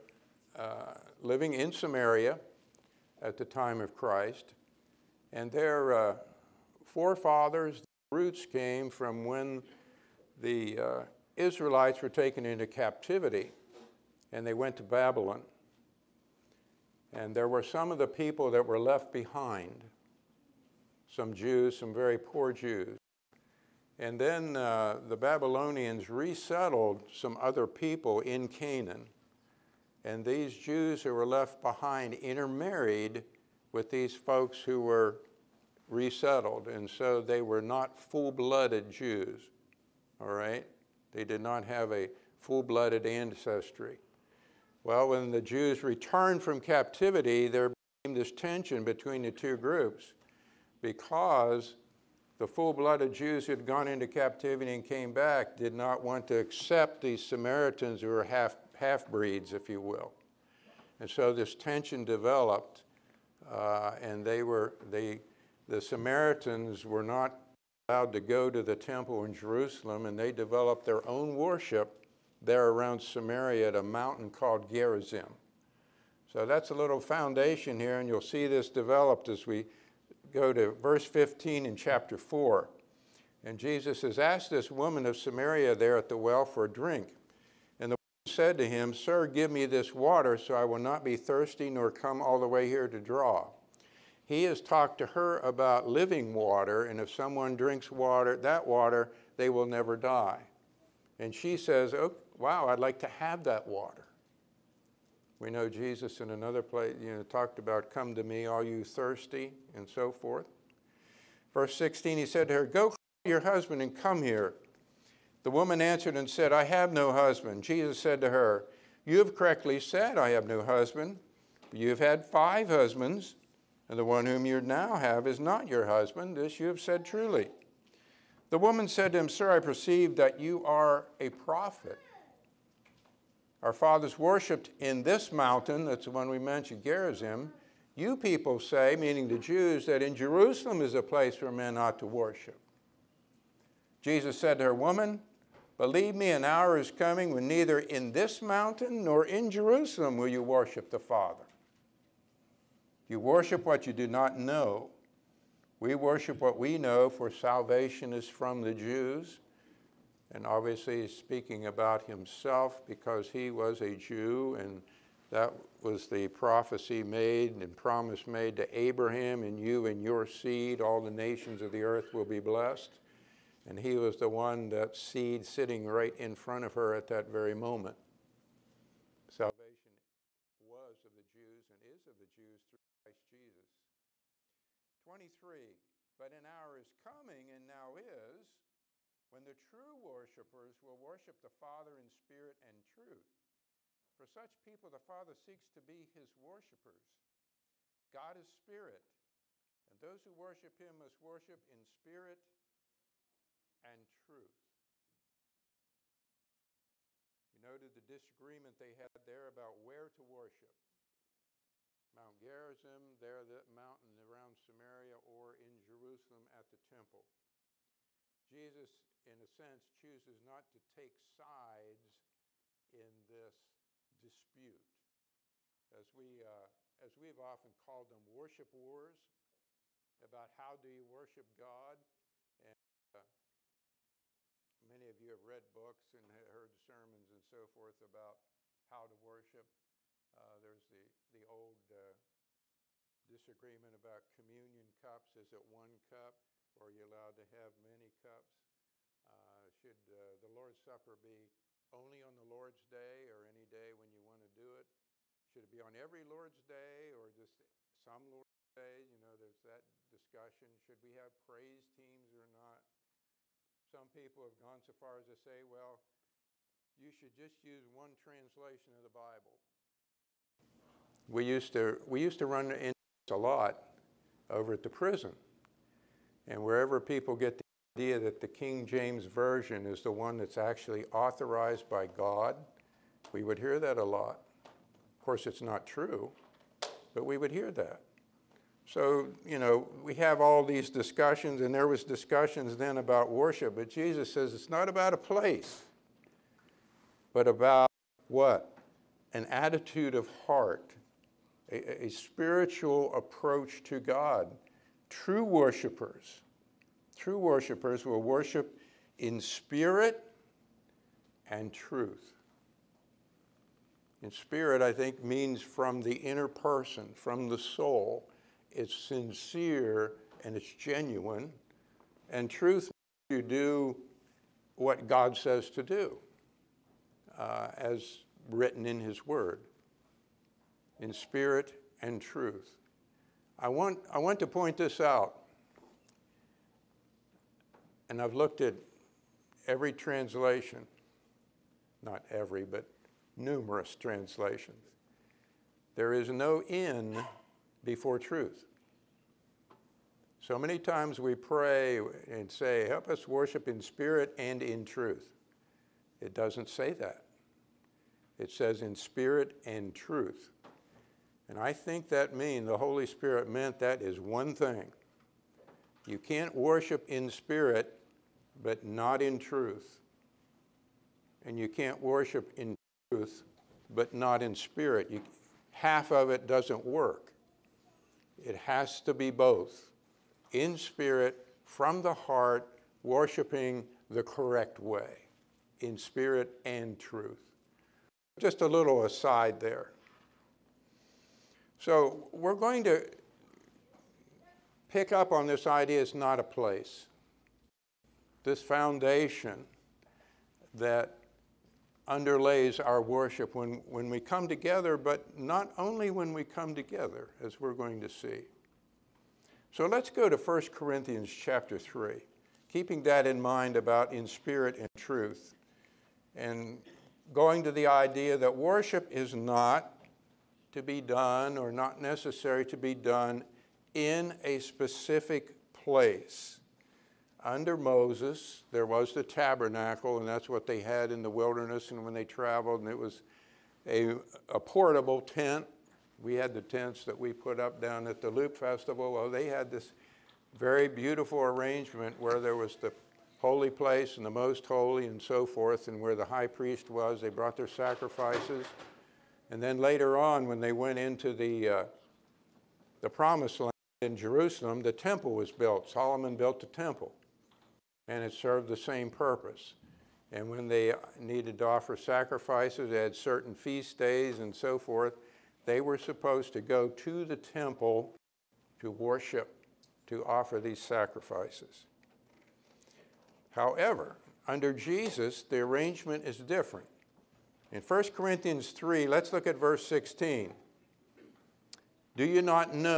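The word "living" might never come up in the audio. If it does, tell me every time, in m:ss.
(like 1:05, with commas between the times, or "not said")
0:01, 1:35.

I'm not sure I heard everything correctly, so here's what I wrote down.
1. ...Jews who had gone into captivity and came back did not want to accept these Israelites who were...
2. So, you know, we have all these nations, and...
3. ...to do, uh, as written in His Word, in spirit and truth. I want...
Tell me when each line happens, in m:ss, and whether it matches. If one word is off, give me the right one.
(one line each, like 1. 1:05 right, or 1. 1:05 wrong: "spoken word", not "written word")
1. 0:53 wrong: "Samaritans", not "Israelites"
2. 4:48 wrong: "discussions", not "nations"
3. 5:25 right.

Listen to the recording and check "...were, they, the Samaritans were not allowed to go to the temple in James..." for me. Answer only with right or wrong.
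wrong.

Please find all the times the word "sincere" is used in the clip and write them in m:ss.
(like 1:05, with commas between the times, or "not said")
5:18.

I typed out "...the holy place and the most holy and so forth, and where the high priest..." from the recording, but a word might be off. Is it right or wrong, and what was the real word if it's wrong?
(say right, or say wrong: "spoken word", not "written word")
right.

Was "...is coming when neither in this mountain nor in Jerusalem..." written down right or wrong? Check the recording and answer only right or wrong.
right.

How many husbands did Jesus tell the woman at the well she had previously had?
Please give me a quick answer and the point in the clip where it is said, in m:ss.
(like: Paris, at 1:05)
5, at 2:02.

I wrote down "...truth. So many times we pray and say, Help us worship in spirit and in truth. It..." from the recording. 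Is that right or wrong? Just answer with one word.
right.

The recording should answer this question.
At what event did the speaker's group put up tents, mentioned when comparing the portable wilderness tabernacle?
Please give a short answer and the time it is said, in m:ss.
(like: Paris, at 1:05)
Loop Festival, at 7:18.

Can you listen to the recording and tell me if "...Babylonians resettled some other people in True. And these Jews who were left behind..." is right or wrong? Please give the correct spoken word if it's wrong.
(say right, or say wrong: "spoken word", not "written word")
wrong: "Canaan", not "True".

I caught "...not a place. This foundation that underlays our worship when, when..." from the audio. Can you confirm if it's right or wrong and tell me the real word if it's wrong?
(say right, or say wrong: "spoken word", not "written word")
right.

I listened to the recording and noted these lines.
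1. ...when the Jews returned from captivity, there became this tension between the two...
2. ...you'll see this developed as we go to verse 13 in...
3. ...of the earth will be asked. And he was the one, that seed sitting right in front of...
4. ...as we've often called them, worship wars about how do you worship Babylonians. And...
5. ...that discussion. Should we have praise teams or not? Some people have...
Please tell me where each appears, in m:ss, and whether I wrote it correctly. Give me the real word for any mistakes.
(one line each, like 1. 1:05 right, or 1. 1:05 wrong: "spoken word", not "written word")
1. 0:45 right
2. 1:18 wrong: "15", not "13"
3. 2:51 wrong: "blessed", not "asked"
4. 3:46 wrong: "God", not "Babylonians"
5. 4:19 right.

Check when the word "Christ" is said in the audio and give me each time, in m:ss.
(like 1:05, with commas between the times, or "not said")
0:03, 3:03.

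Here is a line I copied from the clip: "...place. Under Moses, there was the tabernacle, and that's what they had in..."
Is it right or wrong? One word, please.
right.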